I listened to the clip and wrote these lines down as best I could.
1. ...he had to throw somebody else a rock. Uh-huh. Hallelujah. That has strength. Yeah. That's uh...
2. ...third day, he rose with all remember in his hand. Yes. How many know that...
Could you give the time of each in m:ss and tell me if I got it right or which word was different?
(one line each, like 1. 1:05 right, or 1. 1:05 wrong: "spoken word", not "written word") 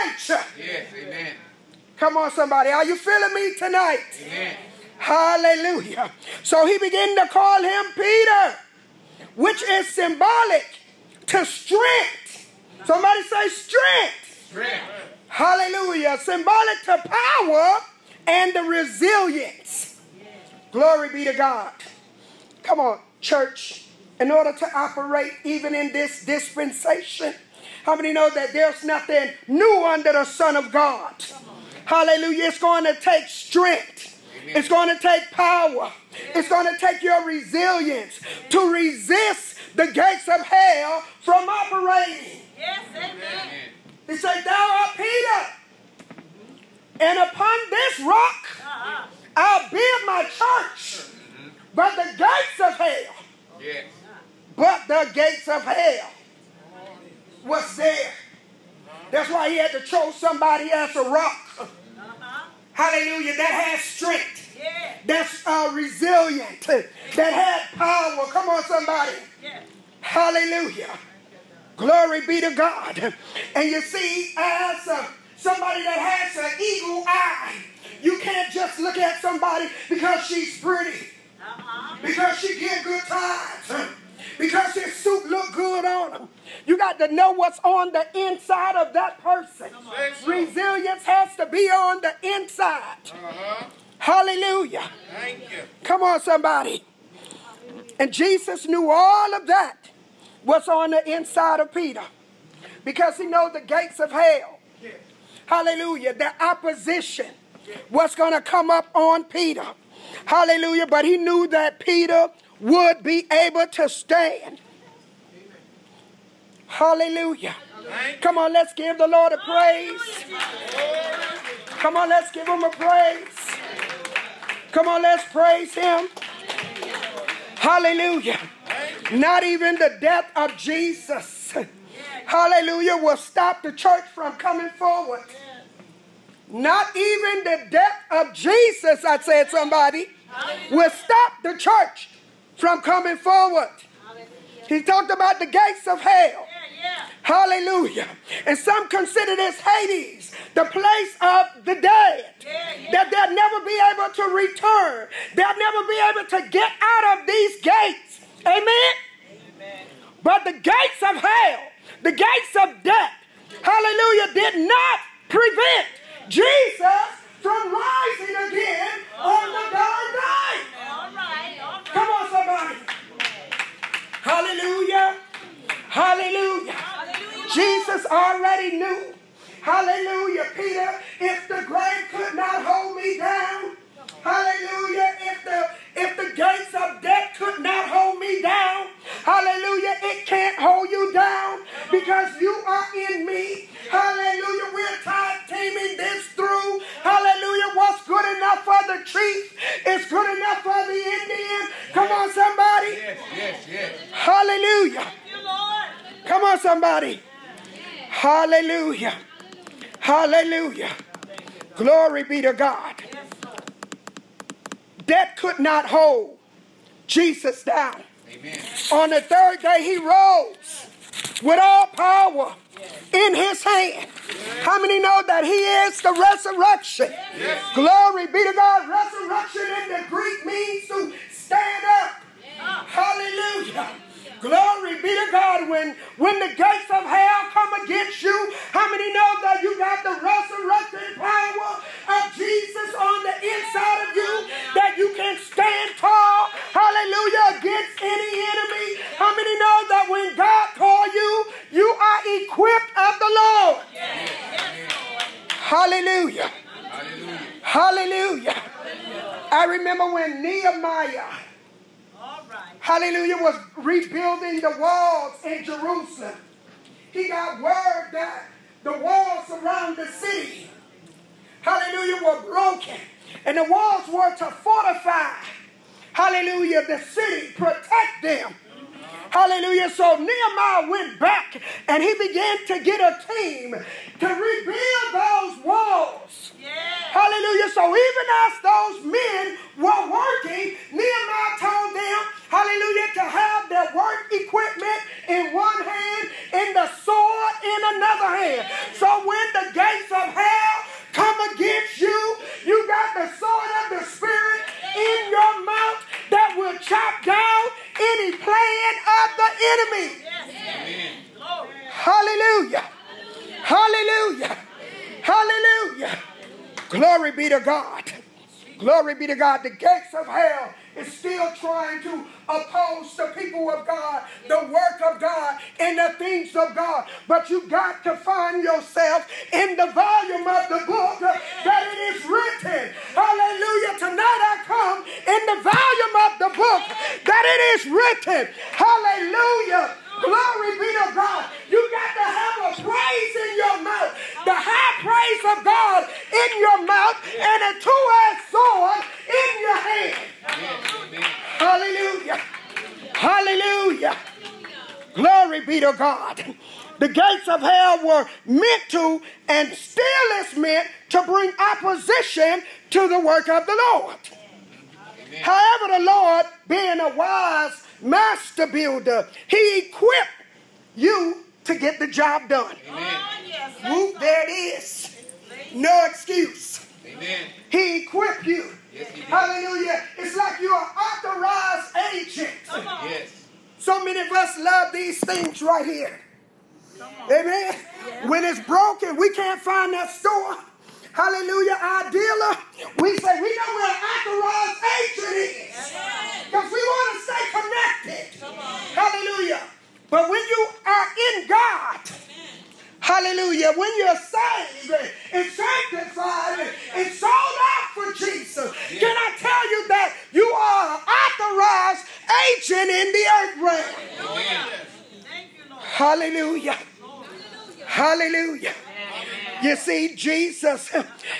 1. 0:59 right
2. 3:39 wrong: "power", not "remember".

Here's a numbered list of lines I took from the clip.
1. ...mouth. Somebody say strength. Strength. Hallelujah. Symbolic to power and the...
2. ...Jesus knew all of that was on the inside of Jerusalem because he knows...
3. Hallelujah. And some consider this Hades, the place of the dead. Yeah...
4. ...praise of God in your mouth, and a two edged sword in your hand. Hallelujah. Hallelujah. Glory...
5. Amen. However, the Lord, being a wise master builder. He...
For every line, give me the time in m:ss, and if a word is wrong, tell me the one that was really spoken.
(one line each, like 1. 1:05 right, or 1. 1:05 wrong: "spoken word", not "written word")
1. 0:11 wrong: "strength", not "mouth"
2. 1:38 wrong: "Peter", not "Jerusalem"
3. 2:27 right
4. 5:45 right
5. 6:04 right.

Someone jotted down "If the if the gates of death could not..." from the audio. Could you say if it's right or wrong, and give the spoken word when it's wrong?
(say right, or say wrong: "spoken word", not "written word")
right.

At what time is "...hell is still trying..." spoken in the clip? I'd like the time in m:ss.
5:20.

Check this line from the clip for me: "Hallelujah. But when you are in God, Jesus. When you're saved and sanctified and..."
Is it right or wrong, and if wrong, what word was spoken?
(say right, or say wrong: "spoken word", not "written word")
wrong: "Hallelujah", not "Jesus".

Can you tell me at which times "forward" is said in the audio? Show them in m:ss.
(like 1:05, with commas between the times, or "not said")
2:14, 2:23.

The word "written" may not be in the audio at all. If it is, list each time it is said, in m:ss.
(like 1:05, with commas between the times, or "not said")
5:32, 5:37.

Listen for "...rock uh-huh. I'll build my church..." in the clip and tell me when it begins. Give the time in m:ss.
0:48.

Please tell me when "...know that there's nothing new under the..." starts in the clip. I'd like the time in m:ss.
0:28.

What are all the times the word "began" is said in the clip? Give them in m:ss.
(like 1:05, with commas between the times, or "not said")
0:06, 4:42.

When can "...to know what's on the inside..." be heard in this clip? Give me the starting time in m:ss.
1:26.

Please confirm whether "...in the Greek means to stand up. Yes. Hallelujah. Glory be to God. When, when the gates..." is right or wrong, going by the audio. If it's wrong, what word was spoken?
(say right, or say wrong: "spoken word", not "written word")
right.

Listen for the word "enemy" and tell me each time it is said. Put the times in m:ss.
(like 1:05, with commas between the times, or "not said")
4:08, 5:09.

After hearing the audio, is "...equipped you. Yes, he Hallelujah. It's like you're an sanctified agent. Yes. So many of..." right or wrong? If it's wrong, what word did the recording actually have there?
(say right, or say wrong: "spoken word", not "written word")
wrong: "authorized", not "sanctified".